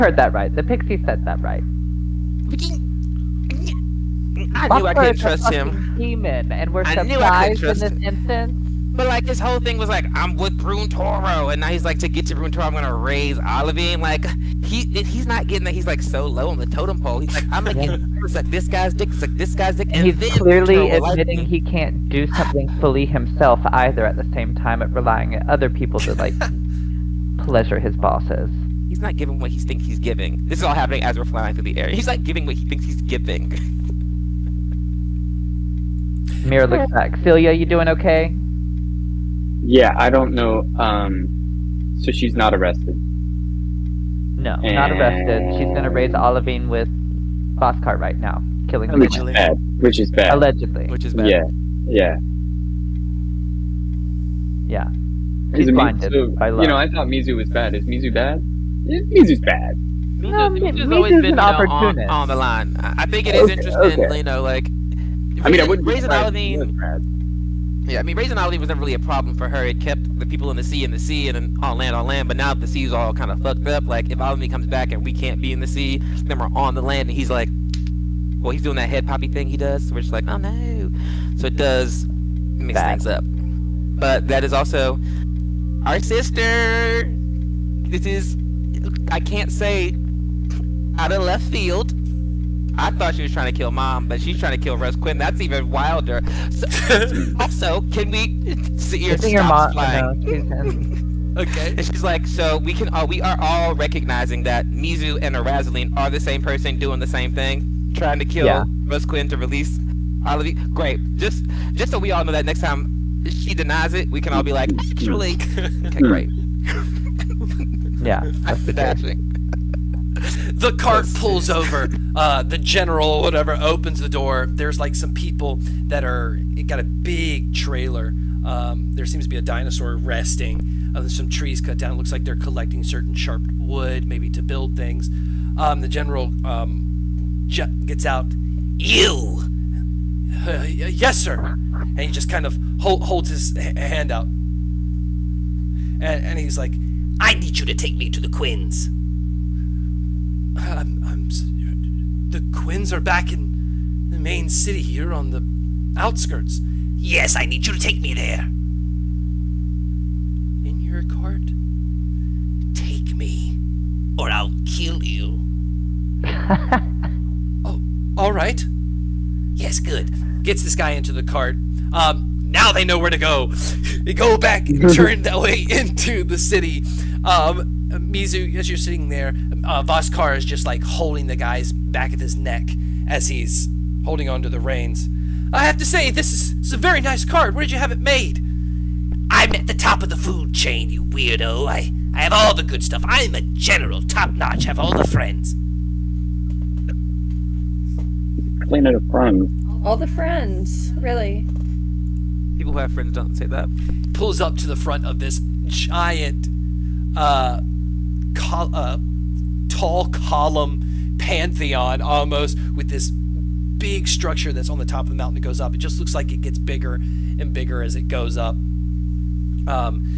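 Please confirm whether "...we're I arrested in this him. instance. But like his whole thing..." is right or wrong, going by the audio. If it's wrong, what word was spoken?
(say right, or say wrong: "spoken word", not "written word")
wrong: "surprised", not "arrested".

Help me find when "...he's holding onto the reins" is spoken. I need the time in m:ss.
3:03.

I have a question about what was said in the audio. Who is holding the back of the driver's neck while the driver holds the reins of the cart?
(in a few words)
Voskar.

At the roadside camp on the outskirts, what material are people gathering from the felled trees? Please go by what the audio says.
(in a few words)
sharp wood.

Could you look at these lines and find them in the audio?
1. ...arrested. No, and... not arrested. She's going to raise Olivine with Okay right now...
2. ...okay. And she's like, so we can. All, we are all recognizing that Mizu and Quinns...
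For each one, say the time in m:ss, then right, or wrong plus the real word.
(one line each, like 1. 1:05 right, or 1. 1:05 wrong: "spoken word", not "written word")
1. 0:42 wrong: "Boss", not "Okay"
2. 1:41 wrong: "Arazaline", not "Quinns".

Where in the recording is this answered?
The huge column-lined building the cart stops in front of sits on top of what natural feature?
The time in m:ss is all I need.
3:35.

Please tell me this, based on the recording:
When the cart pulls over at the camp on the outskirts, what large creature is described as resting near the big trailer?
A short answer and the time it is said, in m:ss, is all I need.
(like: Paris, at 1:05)
dinosaur, at 2:09.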